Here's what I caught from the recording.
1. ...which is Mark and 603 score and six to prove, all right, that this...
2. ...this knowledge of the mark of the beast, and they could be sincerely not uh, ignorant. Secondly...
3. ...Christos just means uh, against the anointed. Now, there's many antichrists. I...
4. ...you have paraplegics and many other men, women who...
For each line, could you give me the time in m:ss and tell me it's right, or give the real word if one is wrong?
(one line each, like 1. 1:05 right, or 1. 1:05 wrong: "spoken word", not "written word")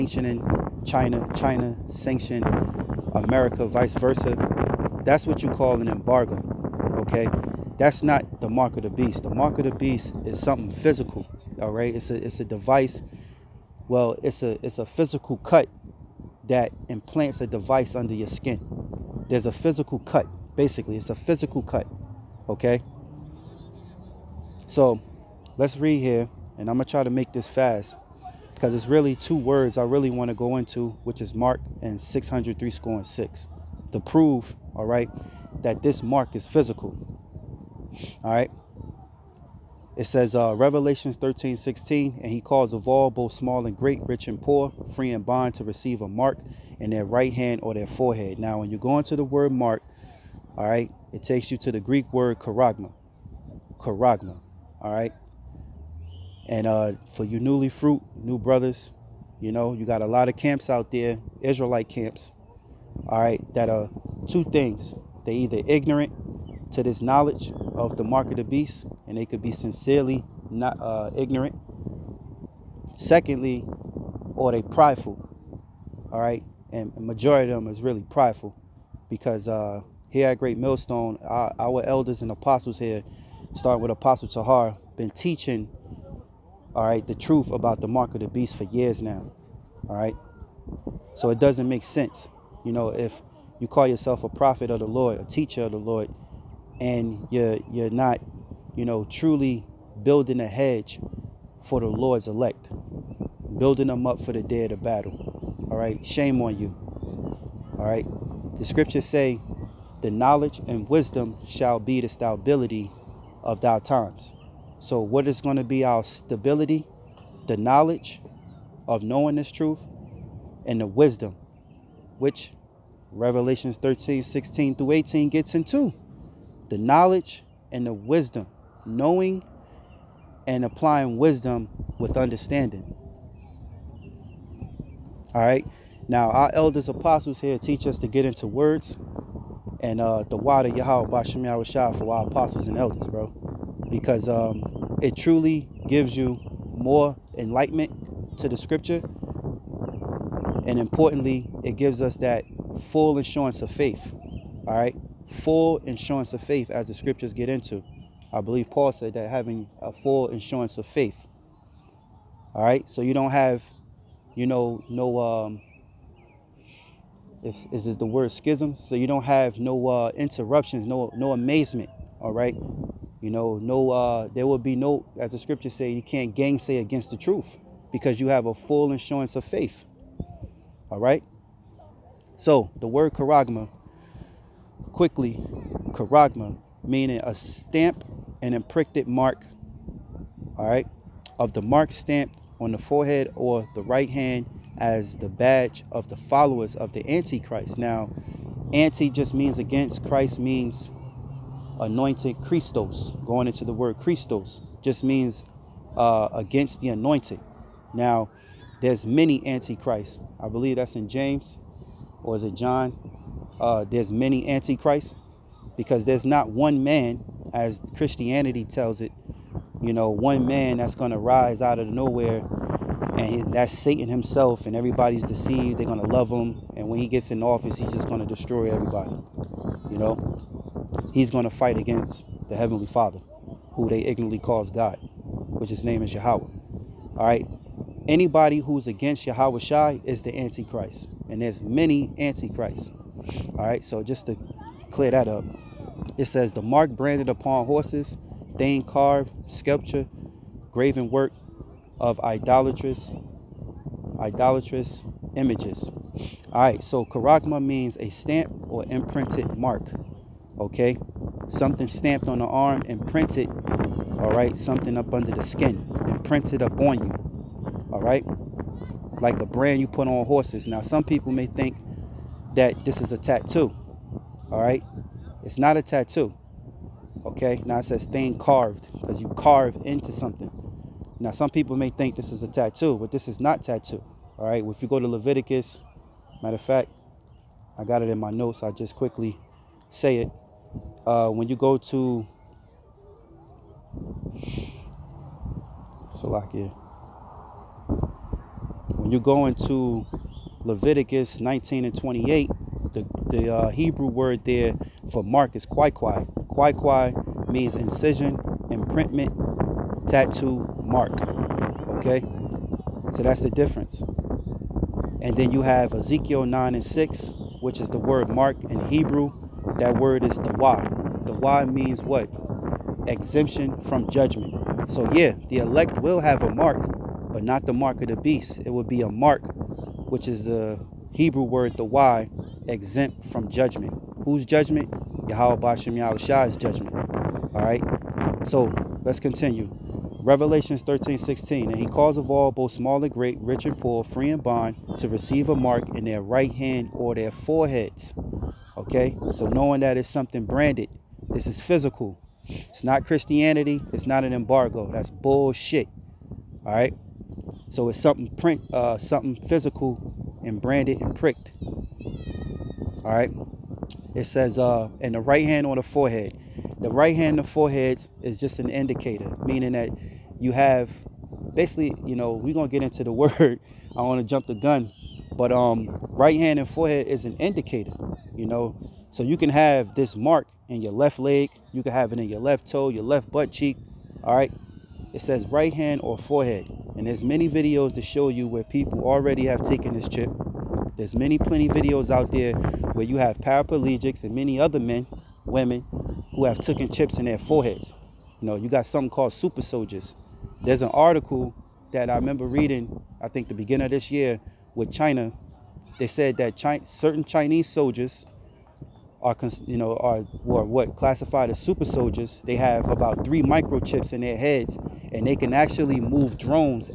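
1. 0:31 right
2. 1:06 right
3. 3:23 right
4. 6:33 right.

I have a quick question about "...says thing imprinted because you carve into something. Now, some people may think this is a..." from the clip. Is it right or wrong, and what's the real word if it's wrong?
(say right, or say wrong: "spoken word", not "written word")
wrong: "carved", not "imprinted".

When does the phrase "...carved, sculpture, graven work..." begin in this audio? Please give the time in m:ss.
4:08.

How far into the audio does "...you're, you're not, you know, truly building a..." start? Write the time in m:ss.
1:37.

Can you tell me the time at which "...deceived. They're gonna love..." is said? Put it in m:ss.
3:45.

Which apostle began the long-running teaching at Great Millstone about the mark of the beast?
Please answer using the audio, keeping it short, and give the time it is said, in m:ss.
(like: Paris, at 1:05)
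Apostle Tahar, at 1:23.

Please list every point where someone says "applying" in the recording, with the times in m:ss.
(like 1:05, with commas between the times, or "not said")
2:10.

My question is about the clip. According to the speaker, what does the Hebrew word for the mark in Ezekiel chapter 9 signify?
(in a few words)
Exemption from judgment.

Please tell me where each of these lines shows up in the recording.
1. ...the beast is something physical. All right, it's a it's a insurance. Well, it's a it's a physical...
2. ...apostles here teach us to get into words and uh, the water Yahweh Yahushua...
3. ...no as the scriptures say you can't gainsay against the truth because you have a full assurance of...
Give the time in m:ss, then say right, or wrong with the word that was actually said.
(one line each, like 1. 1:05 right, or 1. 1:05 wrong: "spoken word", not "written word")
1. 0:09 wrong: "device", not "insurance"
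2. 2:16 wrong: "Bashem", not "Yahushua"
3. 2:54 right.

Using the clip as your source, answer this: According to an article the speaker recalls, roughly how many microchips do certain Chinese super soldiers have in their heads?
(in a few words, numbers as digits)
3.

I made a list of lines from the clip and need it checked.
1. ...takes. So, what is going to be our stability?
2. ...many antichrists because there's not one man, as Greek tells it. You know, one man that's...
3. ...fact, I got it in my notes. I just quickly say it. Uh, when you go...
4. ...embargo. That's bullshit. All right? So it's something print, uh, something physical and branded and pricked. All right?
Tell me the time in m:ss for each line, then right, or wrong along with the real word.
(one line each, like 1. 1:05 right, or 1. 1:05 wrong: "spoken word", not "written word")
1. 1:53 wrong: "times", not "takes"
2. 3:34 wrong: "Christianity", not "Greek"
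3. 4:46 right
4. 5:54 right.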